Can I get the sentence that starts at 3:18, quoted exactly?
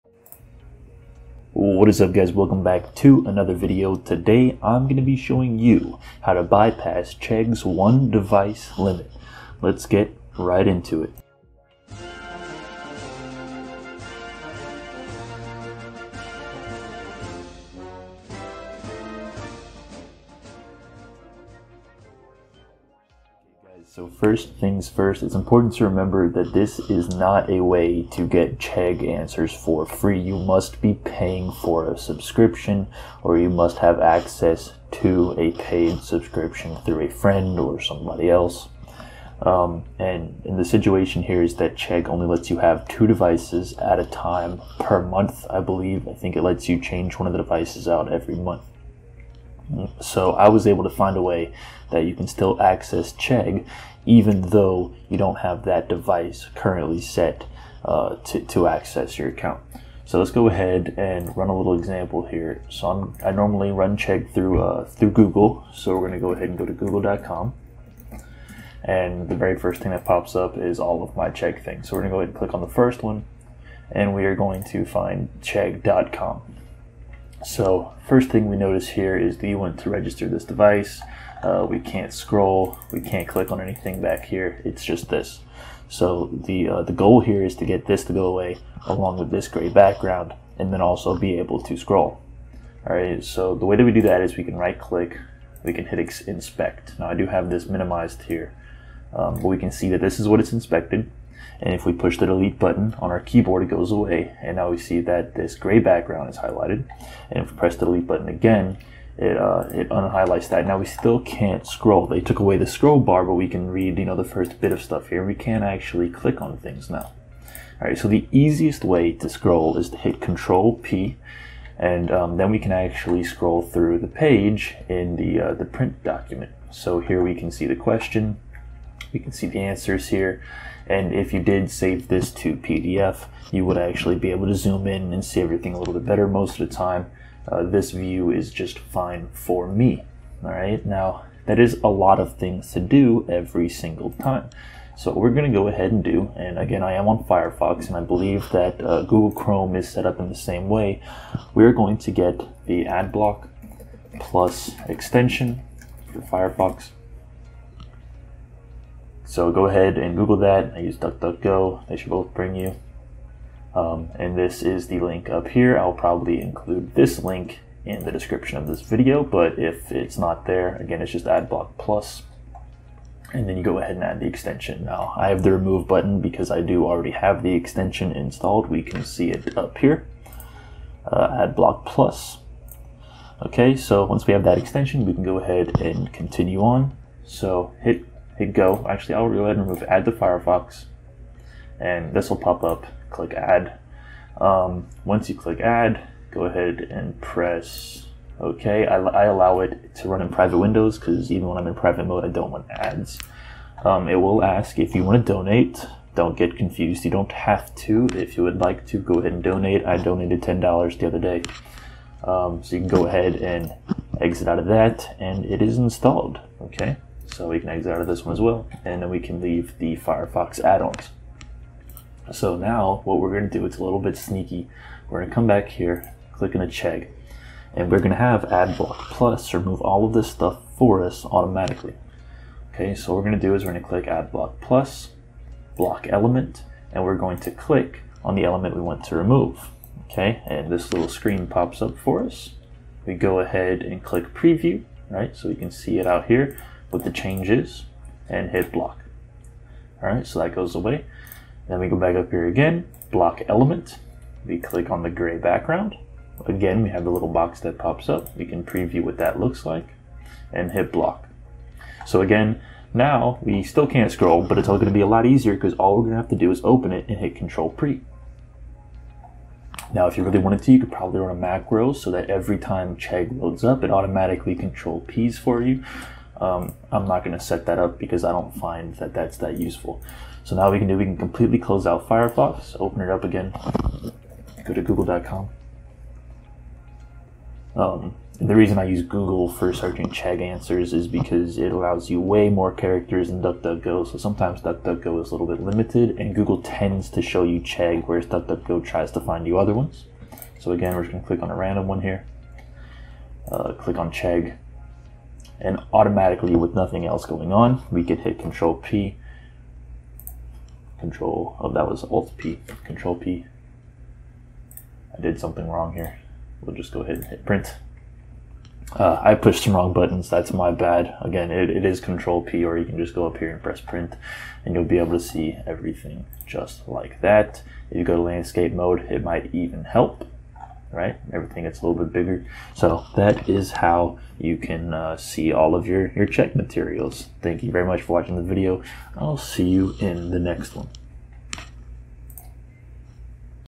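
I, I allow it to run in private windows because even when I'm in private mode, I don't want ads.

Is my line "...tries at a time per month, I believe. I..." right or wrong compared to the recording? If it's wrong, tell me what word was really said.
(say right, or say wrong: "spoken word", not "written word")
wrong: "devices", not "tries".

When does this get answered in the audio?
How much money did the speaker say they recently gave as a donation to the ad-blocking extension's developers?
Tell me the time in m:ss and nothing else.
3:30.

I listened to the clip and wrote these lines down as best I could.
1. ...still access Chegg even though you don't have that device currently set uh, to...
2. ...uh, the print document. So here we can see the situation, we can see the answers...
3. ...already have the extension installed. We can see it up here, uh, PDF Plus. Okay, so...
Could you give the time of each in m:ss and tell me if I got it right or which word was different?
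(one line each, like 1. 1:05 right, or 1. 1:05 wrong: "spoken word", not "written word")
1. 0:52 right
2. 2:05 wrong: "question", not "situation"
3. 2:56 wrong: "AdBlock", not "PDF".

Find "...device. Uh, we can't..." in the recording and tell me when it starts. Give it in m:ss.
1:20.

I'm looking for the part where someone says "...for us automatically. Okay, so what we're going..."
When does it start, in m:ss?
3:50.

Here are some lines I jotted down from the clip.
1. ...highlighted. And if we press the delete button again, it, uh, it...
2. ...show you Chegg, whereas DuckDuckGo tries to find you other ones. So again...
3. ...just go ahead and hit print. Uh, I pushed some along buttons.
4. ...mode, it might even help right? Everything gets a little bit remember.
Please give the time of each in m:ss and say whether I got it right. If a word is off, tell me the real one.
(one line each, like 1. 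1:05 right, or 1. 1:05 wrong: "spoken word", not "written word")
1. 1:46 right
2. 4:57 right
3. 5:16 wrong: "wrong", not "along"
4. 5:28 wrong: "bigger", not "remember".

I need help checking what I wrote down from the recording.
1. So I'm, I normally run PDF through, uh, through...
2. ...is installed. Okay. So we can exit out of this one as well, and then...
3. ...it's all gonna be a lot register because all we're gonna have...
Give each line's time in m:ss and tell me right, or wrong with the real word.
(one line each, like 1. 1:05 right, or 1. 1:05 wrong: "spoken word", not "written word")
1. 1:02 wrong: "Chegg", not "PDF"
2. 3:35 right
3. 4:24 wrong: "easier", not "register".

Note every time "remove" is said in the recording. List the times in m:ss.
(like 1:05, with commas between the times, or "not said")
2:55, 3:09, 3:49, 3:59.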